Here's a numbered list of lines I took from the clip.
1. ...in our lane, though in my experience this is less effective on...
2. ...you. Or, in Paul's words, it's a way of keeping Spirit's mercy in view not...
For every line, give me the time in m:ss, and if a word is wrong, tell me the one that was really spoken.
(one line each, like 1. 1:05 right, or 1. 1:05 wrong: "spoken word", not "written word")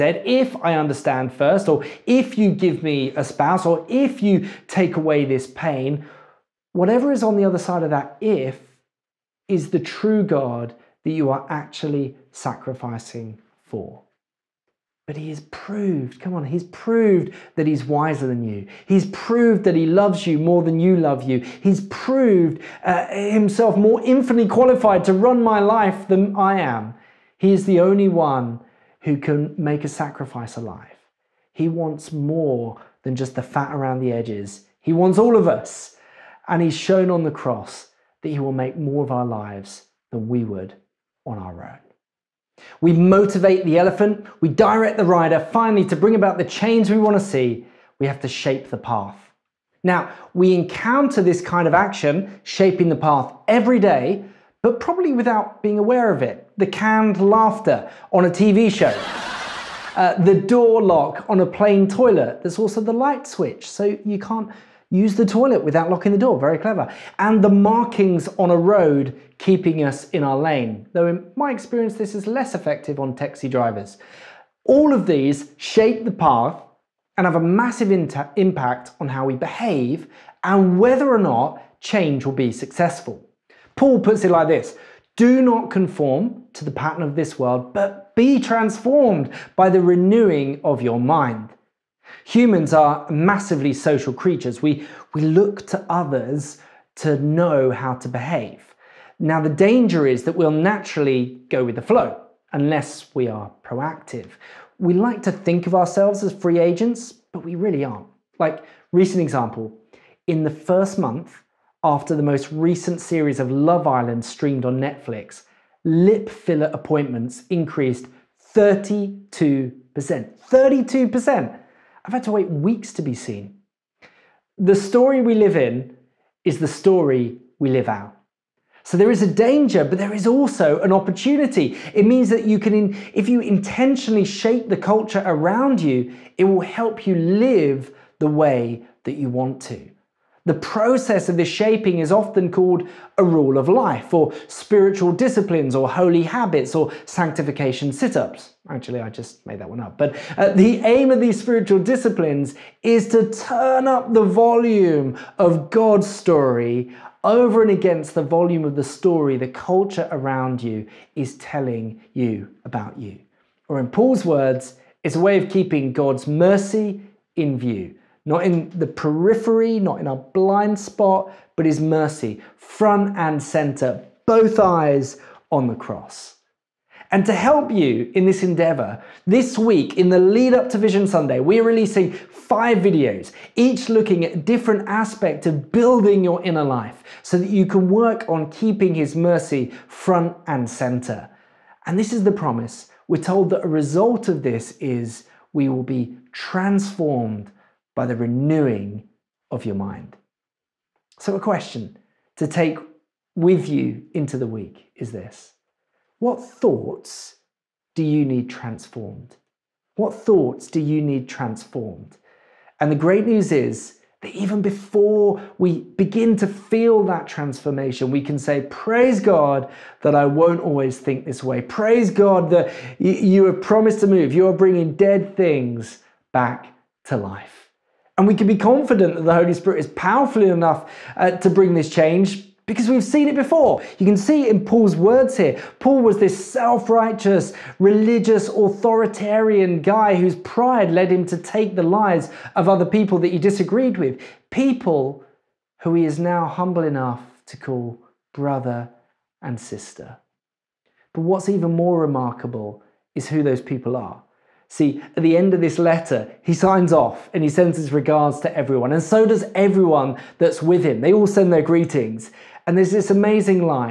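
1. 1:10 right
2. 2:42 wrong: "God", not "Spirit".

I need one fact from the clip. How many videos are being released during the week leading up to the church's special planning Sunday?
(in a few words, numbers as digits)
5.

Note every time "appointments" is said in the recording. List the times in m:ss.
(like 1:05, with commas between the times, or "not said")
1:56.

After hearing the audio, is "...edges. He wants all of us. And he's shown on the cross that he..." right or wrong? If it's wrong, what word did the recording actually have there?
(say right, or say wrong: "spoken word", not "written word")
right.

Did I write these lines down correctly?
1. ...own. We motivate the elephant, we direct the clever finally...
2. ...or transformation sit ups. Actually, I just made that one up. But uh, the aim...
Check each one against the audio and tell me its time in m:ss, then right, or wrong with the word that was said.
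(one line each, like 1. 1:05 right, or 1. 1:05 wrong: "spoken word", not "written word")
1. 0:41 wrong: "rider", not "clever"
2. 2:26 wrong: "sanctification", not "transformation".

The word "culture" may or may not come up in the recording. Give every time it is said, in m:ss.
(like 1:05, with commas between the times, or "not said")
2:14, 2:39.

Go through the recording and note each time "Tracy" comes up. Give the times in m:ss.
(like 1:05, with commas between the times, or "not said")
not said.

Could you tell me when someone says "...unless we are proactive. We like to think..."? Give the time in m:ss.
1:42.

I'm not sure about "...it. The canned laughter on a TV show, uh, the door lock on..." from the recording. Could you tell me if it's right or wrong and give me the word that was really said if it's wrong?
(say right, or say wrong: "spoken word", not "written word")
right.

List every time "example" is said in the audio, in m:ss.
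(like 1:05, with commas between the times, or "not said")
1:49.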